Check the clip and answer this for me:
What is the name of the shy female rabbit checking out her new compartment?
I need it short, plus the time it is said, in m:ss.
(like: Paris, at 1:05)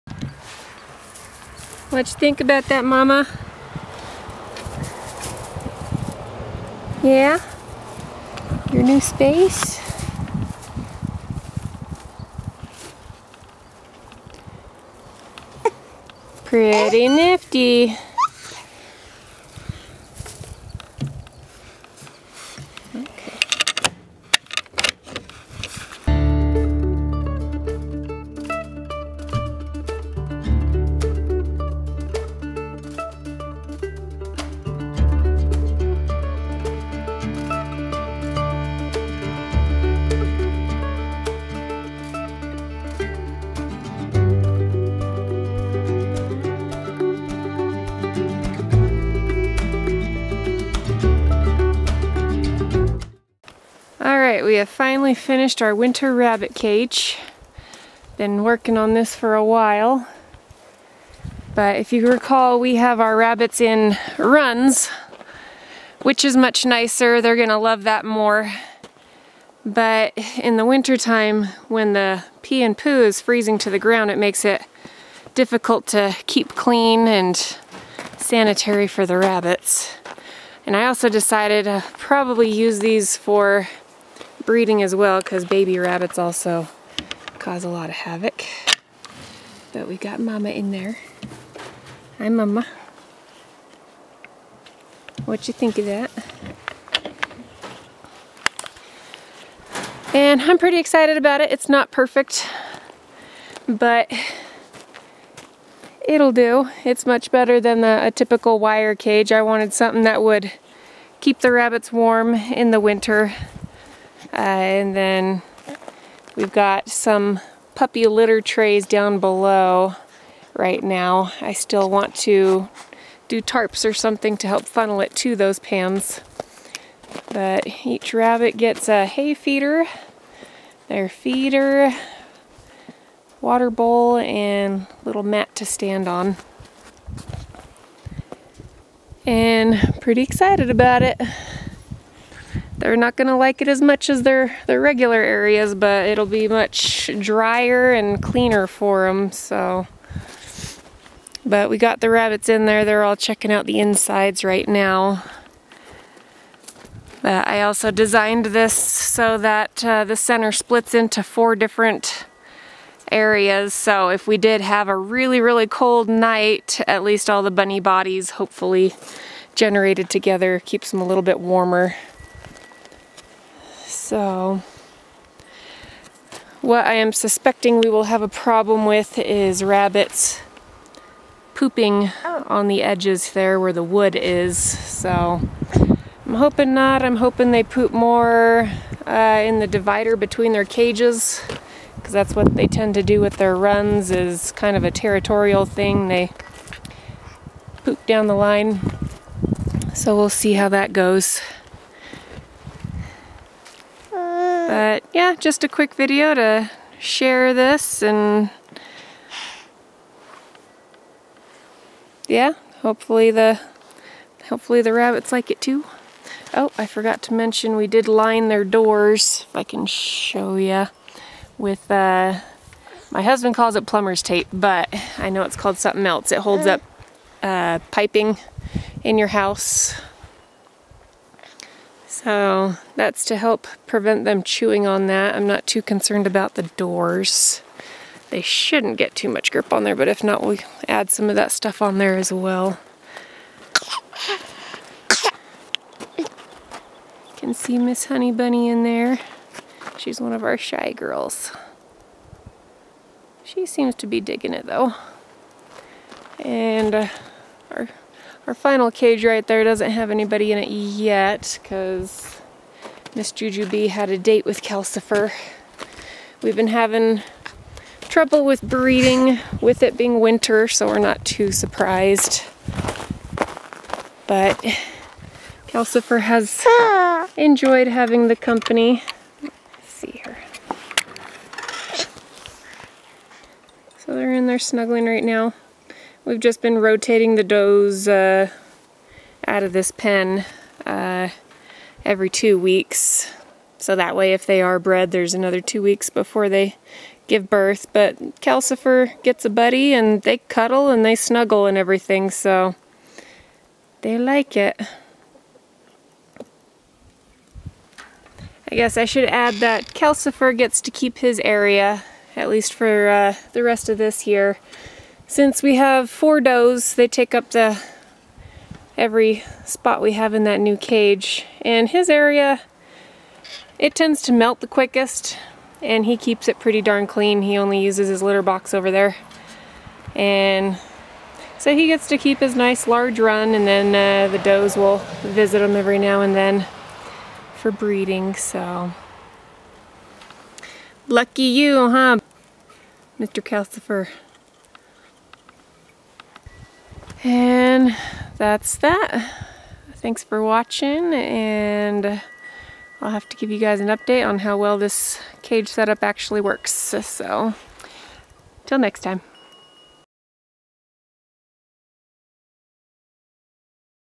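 Miss Honey Bunny, at 4:07.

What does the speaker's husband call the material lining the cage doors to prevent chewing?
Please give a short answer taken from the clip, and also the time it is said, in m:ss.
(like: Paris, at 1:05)
plumber's tape, at 3:43.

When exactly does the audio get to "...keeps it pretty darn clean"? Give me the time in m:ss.
5:26.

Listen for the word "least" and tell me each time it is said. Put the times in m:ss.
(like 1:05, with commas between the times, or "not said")
2:47, 5:12.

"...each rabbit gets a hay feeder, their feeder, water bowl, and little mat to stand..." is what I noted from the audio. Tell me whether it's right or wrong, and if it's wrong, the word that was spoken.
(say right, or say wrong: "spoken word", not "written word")
right.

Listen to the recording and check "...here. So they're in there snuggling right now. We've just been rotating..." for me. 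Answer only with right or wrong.
right.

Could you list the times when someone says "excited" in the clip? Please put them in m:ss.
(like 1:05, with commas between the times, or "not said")
1:40, 2:20.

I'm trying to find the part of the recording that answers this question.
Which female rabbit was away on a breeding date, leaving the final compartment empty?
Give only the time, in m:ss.
4:23.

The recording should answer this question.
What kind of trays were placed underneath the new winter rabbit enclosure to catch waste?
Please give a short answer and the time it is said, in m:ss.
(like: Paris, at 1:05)
puppy litter trays, at 1:57.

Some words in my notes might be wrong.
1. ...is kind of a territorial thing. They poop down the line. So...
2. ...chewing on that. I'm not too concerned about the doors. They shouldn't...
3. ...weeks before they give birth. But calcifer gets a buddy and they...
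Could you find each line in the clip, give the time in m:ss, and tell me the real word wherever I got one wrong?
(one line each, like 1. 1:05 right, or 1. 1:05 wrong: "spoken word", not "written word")
1. 3:14 right
2. 3:54 right
3. 4:55 right.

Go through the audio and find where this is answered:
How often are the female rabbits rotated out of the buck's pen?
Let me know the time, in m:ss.
4:52.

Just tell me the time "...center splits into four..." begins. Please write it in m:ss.
2:40.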